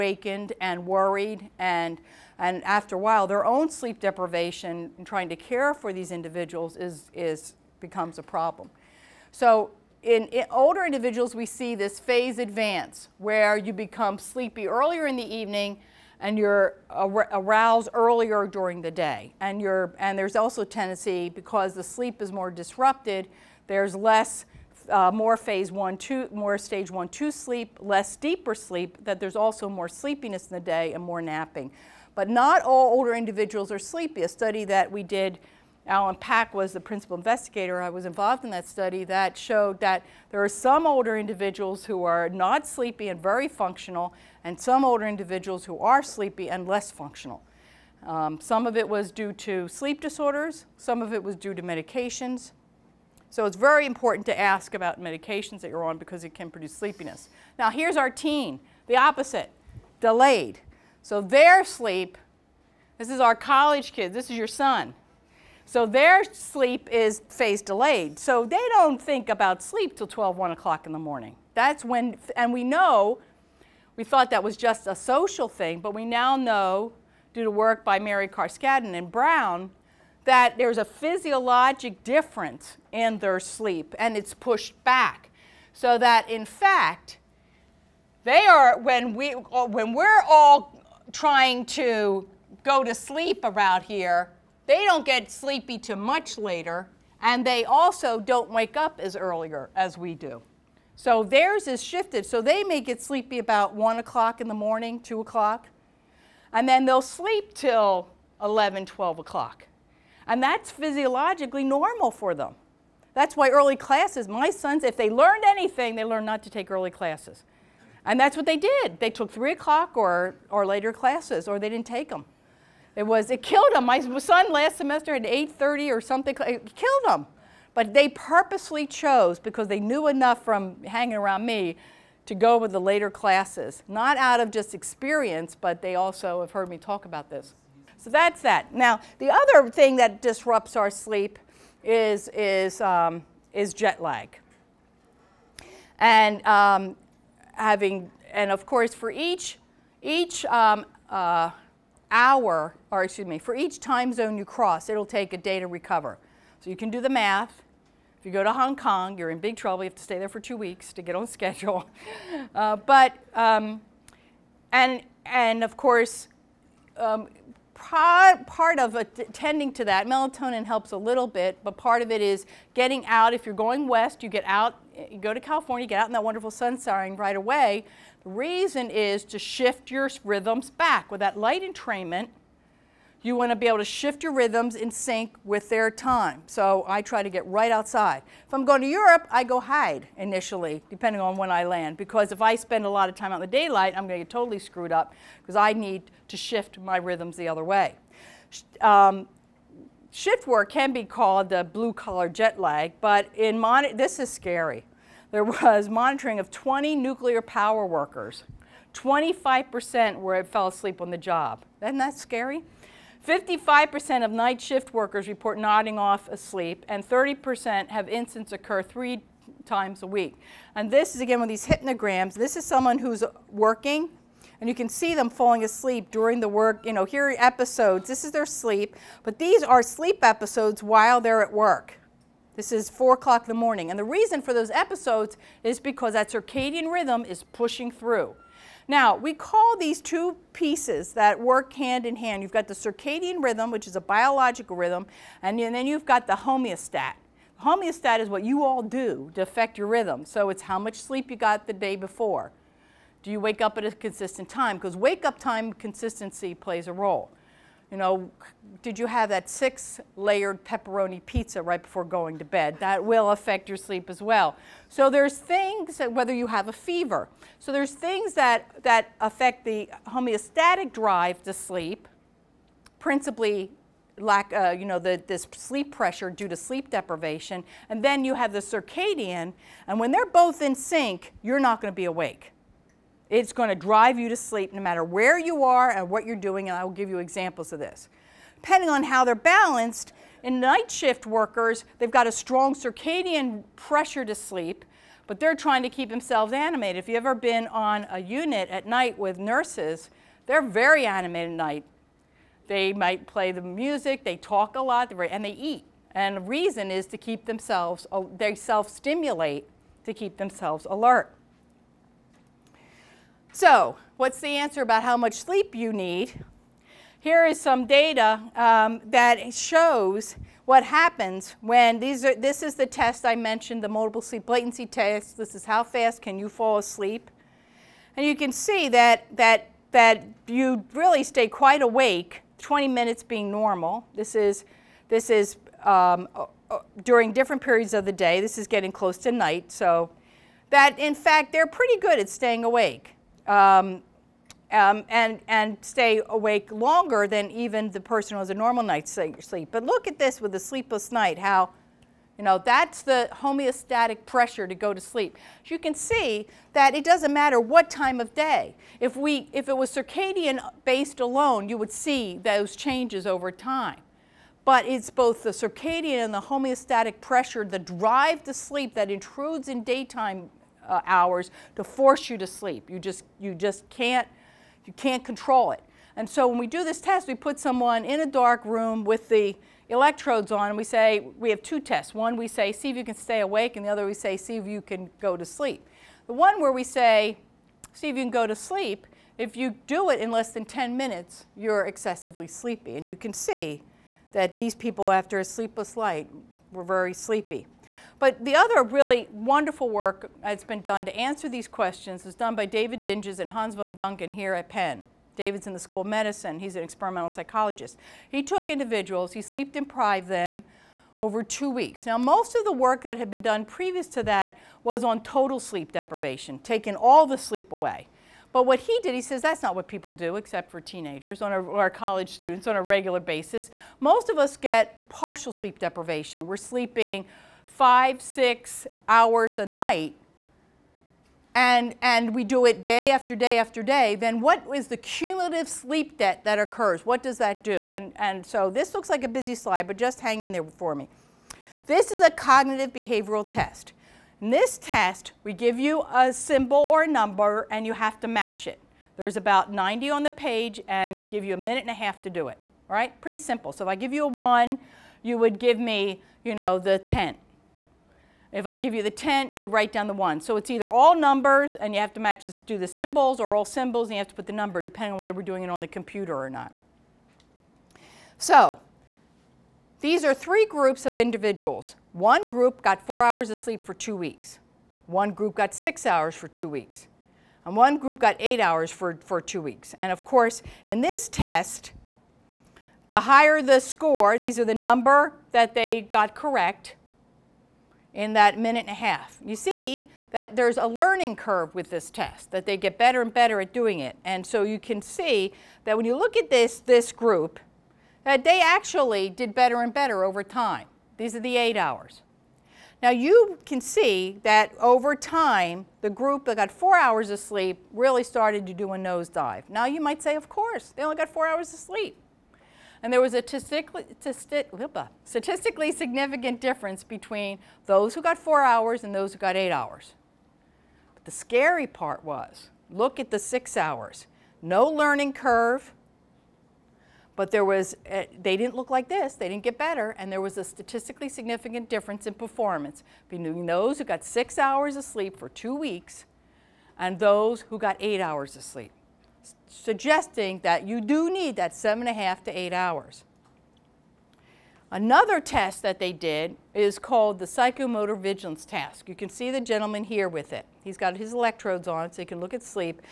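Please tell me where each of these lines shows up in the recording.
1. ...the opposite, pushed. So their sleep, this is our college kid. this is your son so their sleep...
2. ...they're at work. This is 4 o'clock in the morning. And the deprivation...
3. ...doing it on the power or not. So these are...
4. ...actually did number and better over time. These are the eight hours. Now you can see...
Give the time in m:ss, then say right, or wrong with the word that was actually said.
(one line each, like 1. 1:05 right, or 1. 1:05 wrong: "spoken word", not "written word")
1. 0:58 wrong: "delayed", not "pushed"
2. 3:51 wrong: "reason", not "deprivation"
3. 7:45 wrong: "computer", not "power"
4. 8:18 wrong: "better", not "number".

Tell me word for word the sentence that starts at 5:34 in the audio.
This is, this is um, during different periods of the day.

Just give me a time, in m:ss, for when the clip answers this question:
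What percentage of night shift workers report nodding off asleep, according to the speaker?
3:33.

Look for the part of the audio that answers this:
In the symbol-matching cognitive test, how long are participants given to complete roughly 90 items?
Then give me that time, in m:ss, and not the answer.
7:31.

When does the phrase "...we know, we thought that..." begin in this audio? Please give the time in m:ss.
1:12.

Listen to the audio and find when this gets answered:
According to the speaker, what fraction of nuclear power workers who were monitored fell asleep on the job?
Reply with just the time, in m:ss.
3:28.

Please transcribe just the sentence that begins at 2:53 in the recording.
If you're going west, you get out you go to California, get out in that wonderful sunshine right away.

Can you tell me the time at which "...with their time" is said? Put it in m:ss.
3:05.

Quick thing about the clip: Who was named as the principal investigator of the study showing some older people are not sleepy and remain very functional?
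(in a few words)
Alan Pack.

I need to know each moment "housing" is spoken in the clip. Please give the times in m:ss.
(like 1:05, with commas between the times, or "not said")
not said.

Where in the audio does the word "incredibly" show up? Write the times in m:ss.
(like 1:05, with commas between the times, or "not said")
not said.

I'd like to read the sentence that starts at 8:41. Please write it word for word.
But the scary part was, look at the six hours.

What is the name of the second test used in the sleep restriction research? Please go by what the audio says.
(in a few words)
psychomotor vigilance task.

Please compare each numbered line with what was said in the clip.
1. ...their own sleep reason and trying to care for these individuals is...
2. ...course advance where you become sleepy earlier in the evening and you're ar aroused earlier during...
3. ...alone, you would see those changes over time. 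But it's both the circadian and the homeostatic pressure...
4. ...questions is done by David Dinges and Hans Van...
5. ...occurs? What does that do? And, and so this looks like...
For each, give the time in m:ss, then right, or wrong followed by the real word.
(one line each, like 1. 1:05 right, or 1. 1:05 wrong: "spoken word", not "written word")
1. 0:03 wrong: "deprivation", not "reason"
2. 0:11 wrong: "phase", not "course"
3. 6:01 right
4. 6:41 right
5. 7:16 right.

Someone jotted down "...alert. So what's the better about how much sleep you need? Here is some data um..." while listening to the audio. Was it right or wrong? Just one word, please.
wrong.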